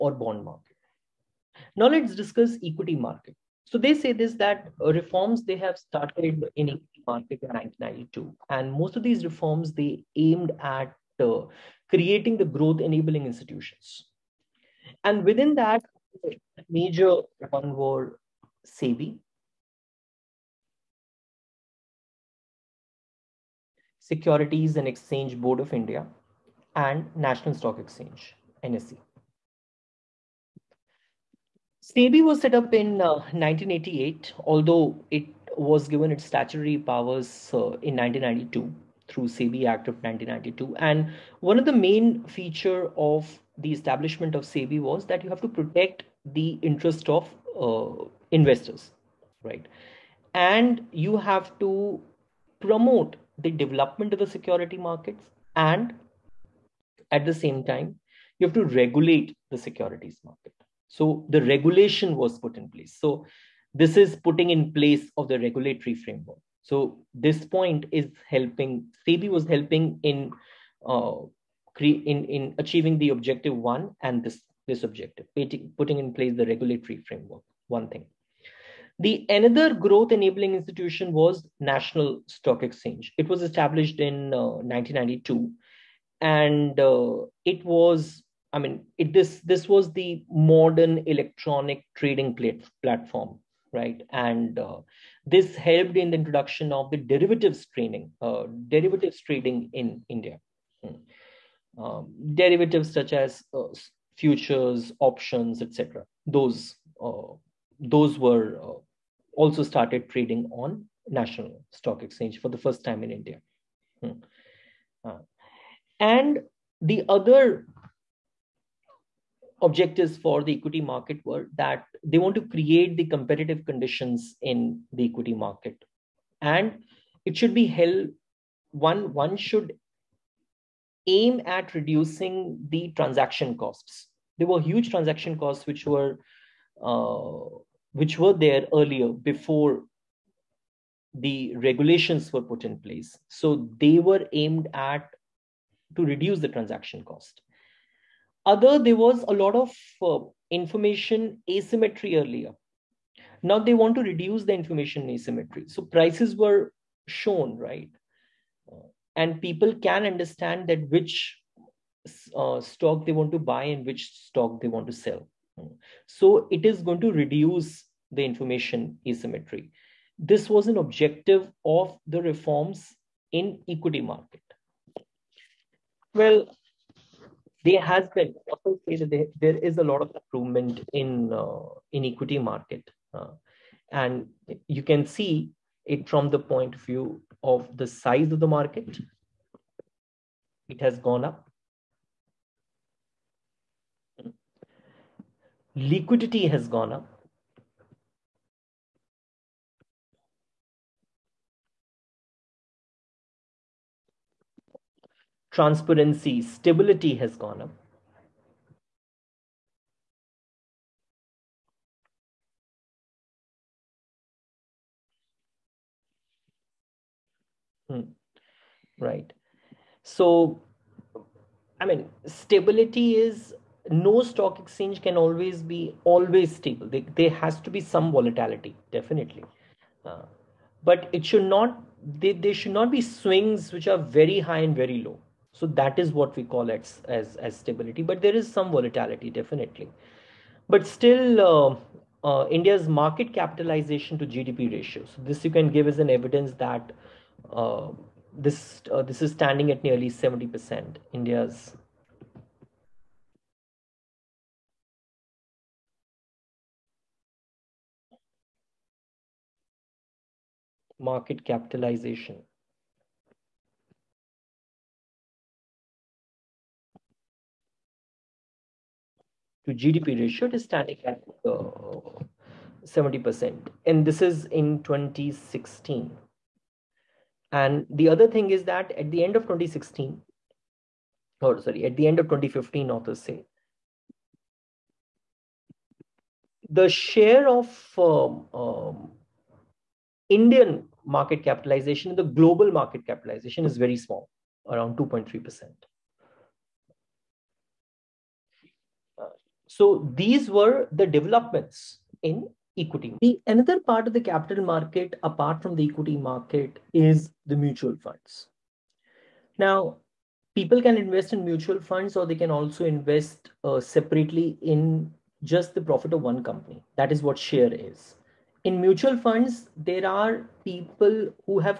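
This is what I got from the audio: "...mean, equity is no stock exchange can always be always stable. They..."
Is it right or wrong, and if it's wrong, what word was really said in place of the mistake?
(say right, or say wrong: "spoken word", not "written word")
wrong: "stability", not "equity".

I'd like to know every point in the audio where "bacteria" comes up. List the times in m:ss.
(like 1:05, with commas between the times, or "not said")
not said.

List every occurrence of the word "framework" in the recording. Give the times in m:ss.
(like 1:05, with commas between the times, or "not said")
1:05, 1:17.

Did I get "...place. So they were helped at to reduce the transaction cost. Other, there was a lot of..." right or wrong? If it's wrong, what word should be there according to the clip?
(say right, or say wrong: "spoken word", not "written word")
wrong: "aimed", not "helped".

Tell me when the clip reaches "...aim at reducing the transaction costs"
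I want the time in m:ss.
2:11.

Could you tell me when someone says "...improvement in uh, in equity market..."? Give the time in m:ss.
3:00.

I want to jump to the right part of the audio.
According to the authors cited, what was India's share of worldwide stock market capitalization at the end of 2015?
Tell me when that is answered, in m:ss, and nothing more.
4:54.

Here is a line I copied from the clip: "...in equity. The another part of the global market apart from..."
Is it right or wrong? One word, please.
wrong.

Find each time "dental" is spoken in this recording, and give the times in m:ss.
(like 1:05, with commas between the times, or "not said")
not said.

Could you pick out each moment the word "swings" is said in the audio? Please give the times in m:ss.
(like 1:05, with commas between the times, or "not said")
3:53.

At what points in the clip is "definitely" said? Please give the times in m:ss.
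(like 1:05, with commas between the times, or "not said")
3:48, 3:59.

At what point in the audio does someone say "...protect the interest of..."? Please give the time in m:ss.
0:45.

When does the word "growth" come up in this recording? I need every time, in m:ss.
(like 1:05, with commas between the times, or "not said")
0:12, 1:19.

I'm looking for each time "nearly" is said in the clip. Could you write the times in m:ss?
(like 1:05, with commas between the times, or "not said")
4:09.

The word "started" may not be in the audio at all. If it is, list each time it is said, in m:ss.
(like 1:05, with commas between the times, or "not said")
0:05, 1:49.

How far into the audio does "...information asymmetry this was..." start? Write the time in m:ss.
2:48.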